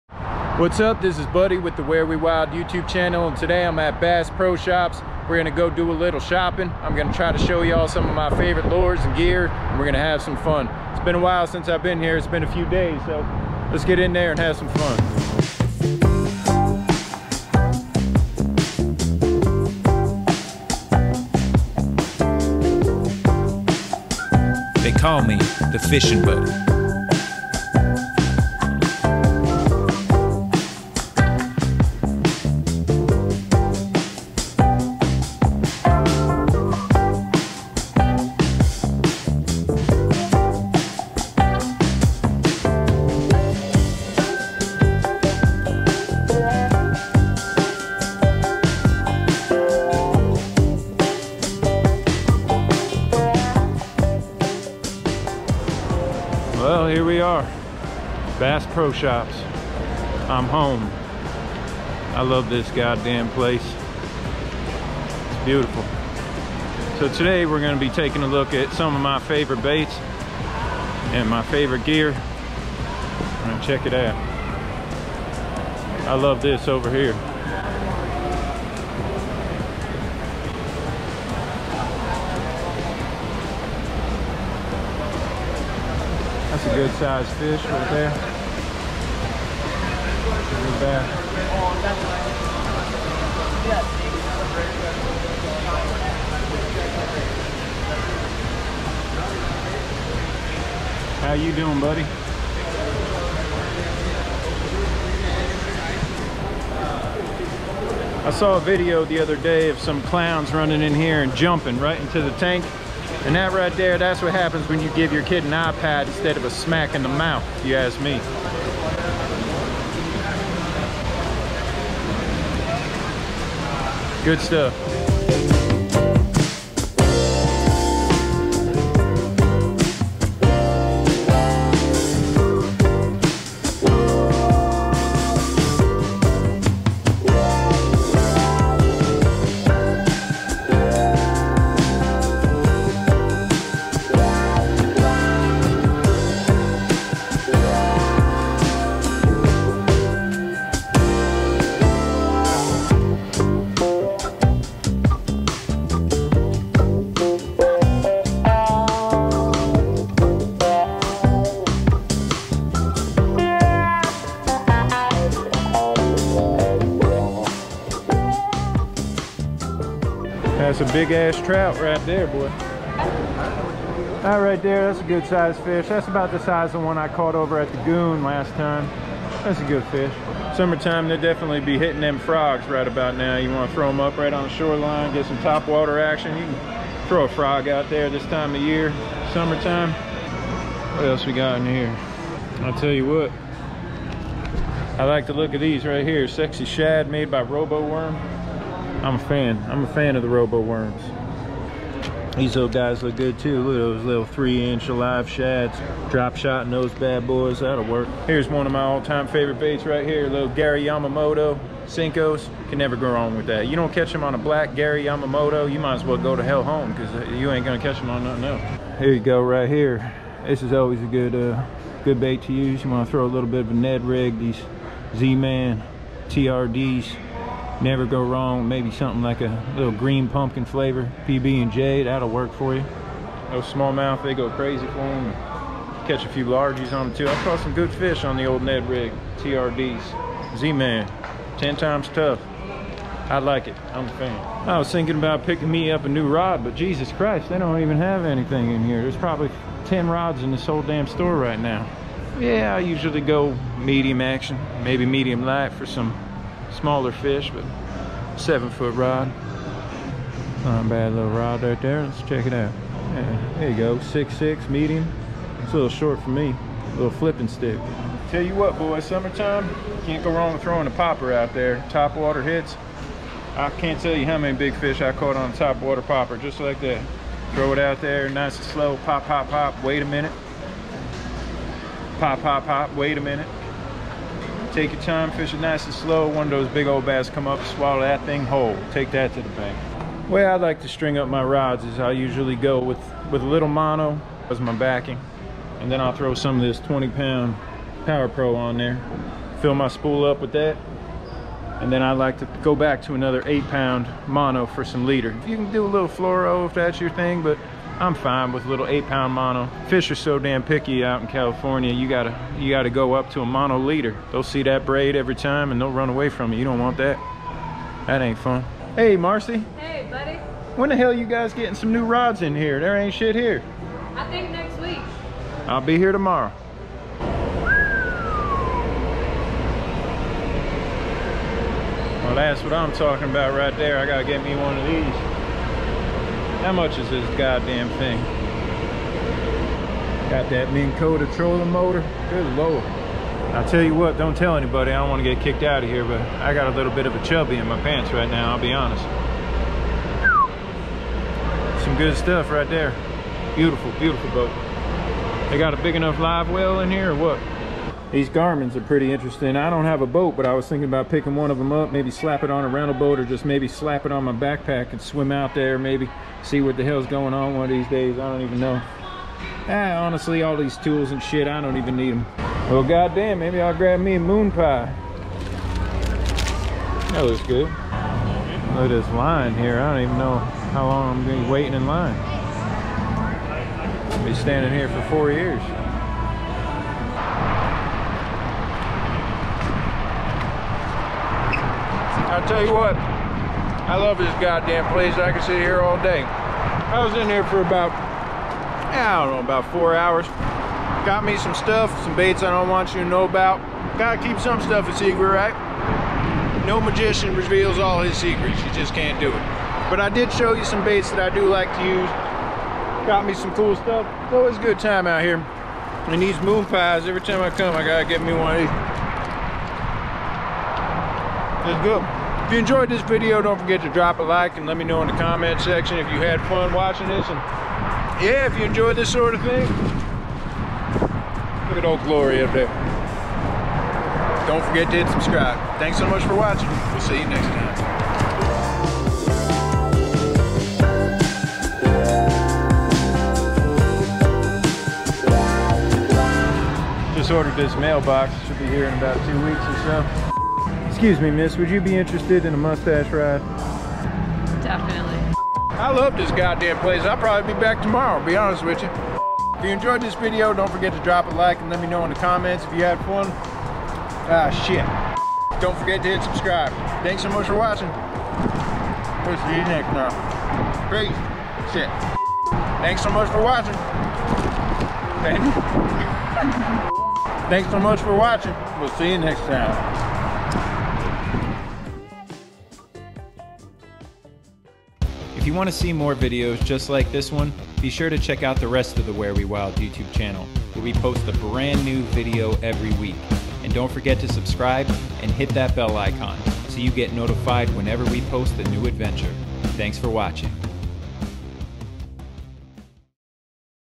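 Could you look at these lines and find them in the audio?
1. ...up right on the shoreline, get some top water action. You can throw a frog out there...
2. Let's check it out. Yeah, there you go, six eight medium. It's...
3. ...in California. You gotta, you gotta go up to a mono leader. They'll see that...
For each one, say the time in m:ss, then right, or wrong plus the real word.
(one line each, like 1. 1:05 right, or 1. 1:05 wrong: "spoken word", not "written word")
1. 3:03 right
2. 4:22 wrong: "six", not "eight"
3. 5:11 right.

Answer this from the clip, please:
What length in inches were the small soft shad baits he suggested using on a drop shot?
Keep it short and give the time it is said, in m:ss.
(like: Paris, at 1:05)
3, at 3:24.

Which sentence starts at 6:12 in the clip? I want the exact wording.
Well, goddamn, maybe I'll grab me a moon pie.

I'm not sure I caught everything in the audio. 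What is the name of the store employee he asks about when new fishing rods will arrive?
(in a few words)
Marcy.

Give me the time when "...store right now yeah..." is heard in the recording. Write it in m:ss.
4:11.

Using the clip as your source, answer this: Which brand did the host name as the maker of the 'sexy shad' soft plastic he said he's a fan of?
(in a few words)
Robo Worm.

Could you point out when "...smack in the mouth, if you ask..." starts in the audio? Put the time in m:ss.
1:56.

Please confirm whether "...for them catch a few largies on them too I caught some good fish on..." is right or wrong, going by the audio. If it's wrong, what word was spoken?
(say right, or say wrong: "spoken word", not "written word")
right.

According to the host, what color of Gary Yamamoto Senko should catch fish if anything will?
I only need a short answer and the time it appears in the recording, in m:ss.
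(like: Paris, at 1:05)
black, at 3:34.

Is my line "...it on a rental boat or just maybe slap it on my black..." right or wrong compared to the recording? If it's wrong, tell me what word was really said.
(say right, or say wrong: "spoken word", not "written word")
wrong: "backpack", not "black".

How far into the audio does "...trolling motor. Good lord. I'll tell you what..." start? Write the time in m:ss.
5:41.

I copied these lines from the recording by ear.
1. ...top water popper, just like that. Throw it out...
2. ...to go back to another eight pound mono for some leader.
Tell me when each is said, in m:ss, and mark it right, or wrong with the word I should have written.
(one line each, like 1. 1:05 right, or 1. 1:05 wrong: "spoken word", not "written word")
1. 4:35 right
2. 5:02 right.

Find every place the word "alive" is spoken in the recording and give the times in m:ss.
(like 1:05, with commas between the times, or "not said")
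3:24.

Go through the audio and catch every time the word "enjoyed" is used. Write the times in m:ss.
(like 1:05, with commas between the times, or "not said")
7:02, 7:08, 7:39.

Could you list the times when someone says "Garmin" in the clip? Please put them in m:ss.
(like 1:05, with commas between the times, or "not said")
5:58.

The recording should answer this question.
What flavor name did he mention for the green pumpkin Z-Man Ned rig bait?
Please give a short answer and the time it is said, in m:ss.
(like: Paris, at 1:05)
PB&J, at 3:51.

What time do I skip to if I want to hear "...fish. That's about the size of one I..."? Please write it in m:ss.
2:55.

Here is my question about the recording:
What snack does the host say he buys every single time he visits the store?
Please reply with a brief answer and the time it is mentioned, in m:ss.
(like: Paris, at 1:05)
moon pie, at 6:56.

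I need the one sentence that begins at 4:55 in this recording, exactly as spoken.
And then I'll throw some of this 20 pound Power Pro on there.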